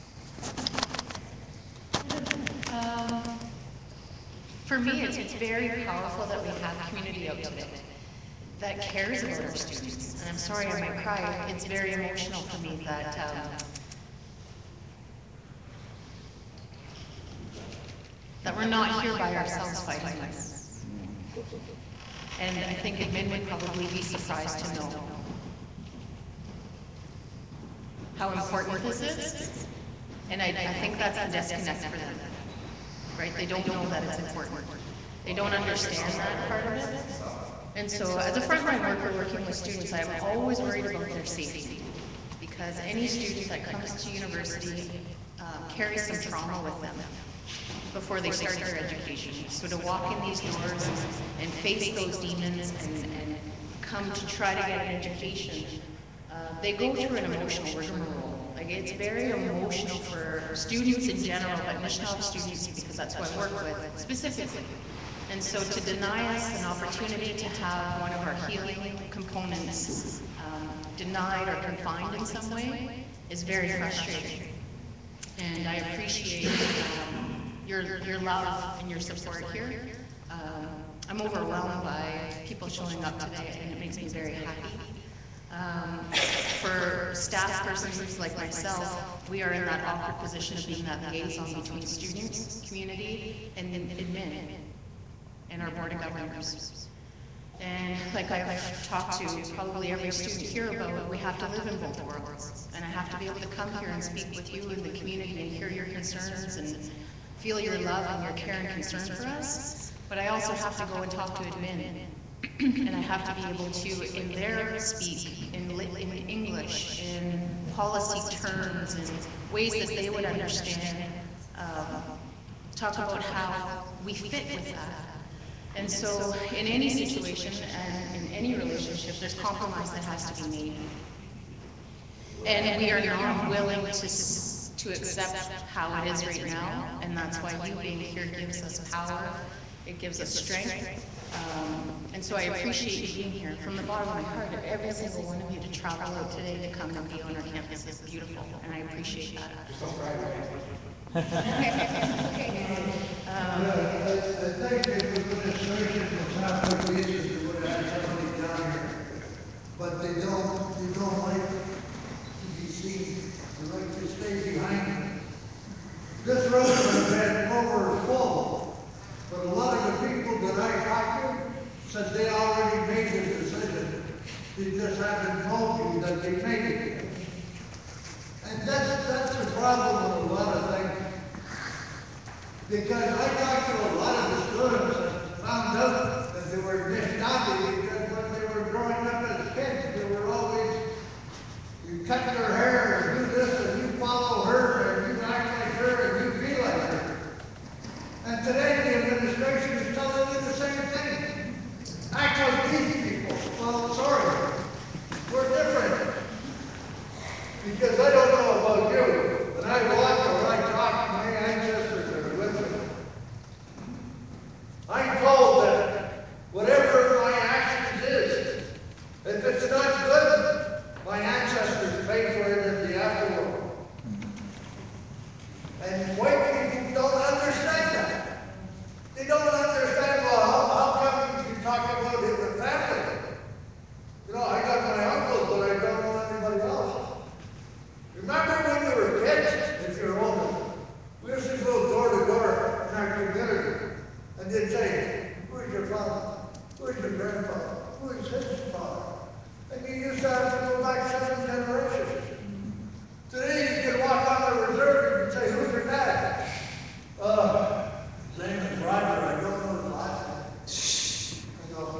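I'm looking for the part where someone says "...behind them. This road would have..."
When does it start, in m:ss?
2:44.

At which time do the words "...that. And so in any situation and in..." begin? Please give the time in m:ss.
2:04.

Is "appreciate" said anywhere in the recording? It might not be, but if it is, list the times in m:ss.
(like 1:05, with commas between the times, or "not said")
1:15, 2:22, 2:28.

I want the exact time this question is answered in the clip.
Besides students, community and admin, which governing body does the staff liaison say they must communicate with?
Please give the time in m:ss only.
1:35.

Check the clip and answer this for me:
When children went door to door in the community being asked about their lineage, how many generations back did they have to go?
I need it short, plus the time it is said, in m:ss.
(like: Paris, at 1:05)
7, at 4:11.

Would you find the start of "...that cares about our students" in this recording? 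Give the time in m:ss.
0:08.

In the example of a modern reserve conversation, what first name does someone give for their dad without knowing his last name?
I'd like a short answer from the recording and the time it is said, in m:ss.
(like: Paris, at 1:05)
Roger, at 4:18.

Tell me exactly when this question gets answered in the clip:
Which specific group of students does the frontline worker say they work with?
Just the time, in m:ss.
1:01.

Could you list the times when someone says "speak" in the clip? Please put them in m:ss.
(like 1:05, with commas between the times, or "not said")
1:44, 1:54.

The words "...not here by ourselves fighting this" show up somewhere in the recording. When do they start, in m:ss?
0:18.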